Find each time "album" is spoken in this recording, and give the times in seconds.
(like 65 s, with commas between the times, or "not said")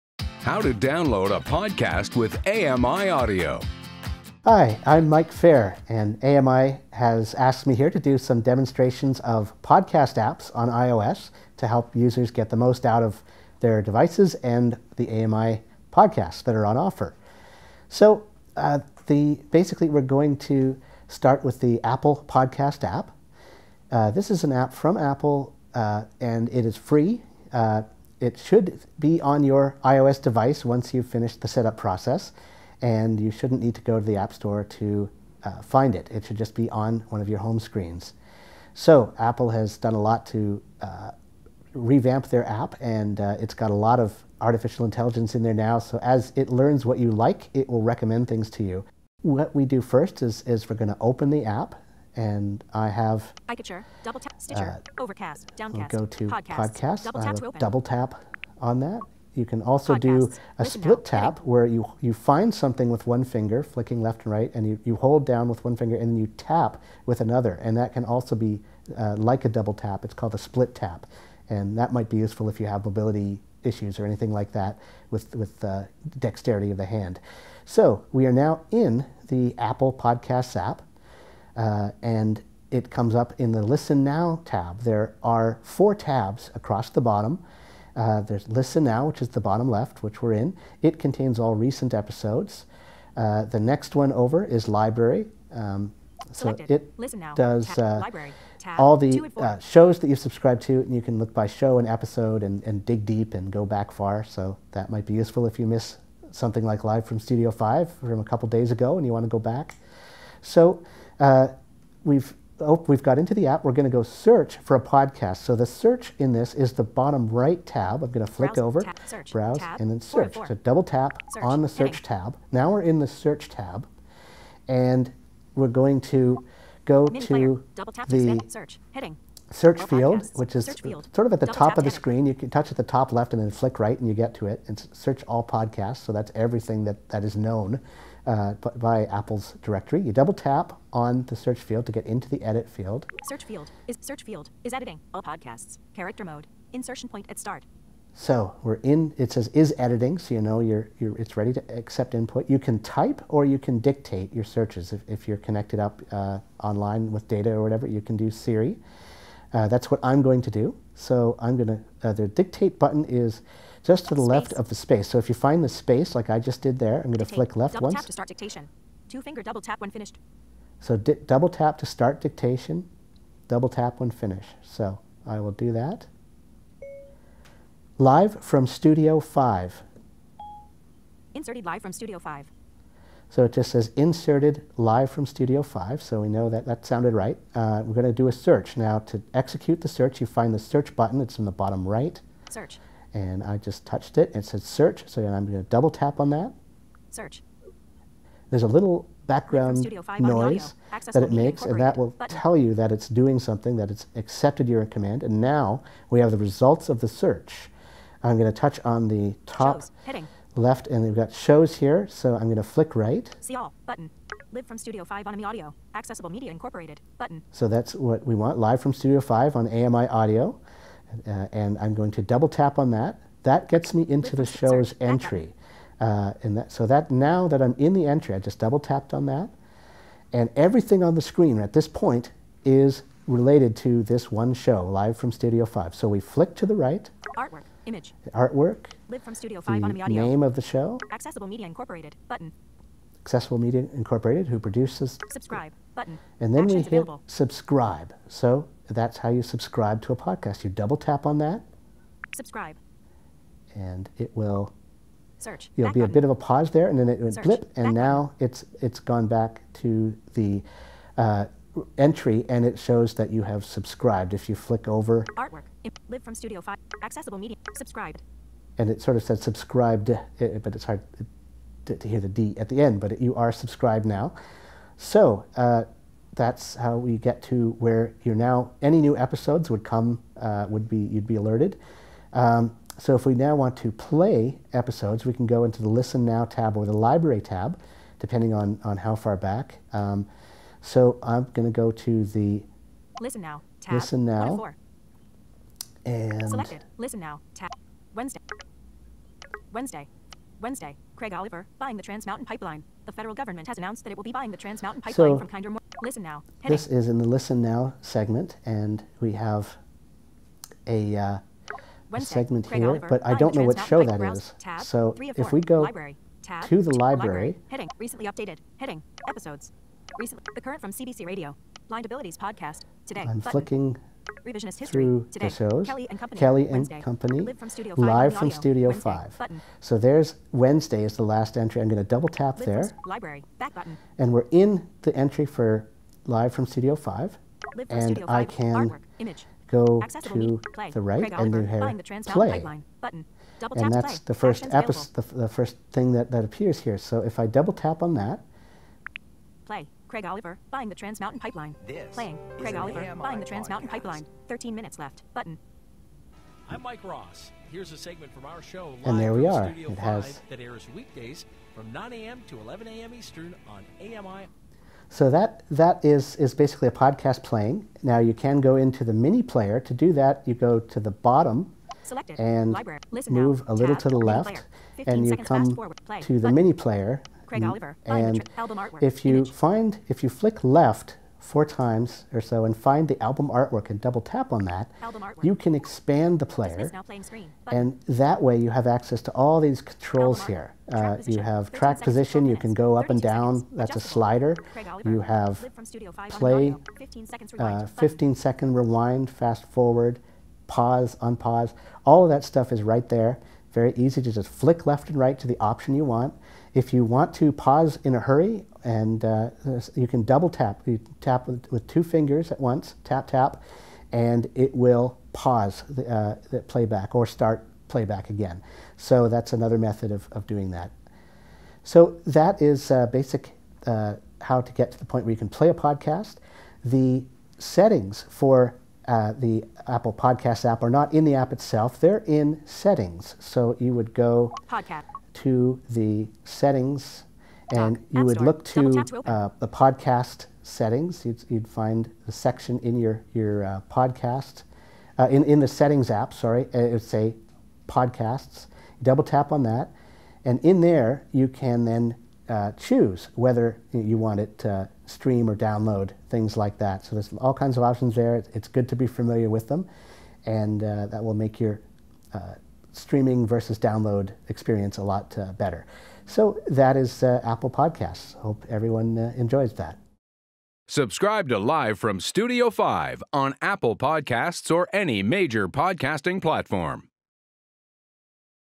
378 s, 383 s.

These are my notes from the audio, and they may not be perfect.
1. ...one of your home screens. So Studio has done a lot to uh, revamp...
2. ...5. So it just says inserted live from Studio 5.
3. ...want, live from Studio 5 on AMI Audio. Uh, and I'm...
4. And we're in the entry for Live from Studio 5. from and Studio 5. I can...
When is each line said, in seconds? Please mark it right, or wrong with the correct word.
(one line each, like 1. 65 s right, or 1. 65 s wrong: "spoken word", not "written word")
1. 37 s wrong: "Apple", not "Studio"
2. 182 s right
3. 218 s right
4. 334 s right.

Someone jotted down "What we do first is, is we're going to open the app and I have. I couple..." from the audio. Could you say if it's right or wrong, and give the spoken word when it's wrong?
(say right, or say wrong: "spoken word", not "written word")
wrong: "double", not "couple".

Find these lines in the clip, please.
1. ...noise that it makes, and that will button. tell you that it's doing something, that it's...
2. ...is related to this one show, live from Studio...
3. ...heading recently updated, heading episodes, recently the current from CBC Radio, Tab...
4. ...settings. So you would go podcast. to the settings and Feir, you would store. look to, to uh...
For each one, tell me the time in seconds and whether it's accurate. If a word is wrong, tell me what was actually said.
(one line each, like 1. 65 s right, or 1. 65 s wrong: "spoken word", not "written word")
1. 200 s right
2. 232 s right
3. 317 s wrong: "Blind", not "Tab"
4. 432 s wrong: "Doc", not "Feir".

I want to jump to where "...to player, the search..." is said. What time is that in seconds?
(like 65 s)
127 s.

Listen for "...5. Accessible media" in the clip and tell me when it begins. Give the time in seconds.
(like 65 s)
266 s.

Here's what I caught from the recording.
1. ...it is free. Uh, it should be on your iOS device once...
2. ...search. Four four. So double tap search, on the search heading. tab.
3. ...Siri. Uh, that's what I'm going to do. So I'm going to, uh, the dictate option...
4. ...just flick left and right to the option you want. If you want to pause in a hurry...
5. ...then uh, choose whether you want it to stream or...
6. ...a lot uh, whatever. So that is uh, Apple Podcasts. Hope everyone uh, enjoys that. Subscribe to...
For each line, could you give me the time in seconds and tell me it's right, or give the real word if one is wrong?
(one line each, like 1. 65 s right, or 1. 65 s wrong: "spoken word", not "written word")
1. 26 s right
2. 120 s right
3. 158 s wrong: "button", not "option"
4. 404 s right
5. 451 s right
6. 464 s wrong: "better", not "whatever".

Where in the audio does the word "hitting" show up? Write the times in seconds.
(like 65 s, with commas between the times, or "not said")
210 s.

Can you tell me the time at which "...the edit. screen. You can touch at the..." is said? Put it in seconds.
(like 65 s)
131 s.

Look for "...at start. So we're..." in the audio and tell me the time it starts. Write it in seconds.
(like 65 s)
147 s.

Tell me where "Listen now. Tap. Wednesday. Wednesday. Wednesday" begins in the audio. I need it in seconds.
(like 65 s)
296 s.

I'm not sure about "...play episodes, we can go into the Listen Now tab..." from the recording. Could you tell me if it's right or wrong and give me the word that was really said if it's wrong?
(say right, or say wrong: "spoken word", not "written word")
right.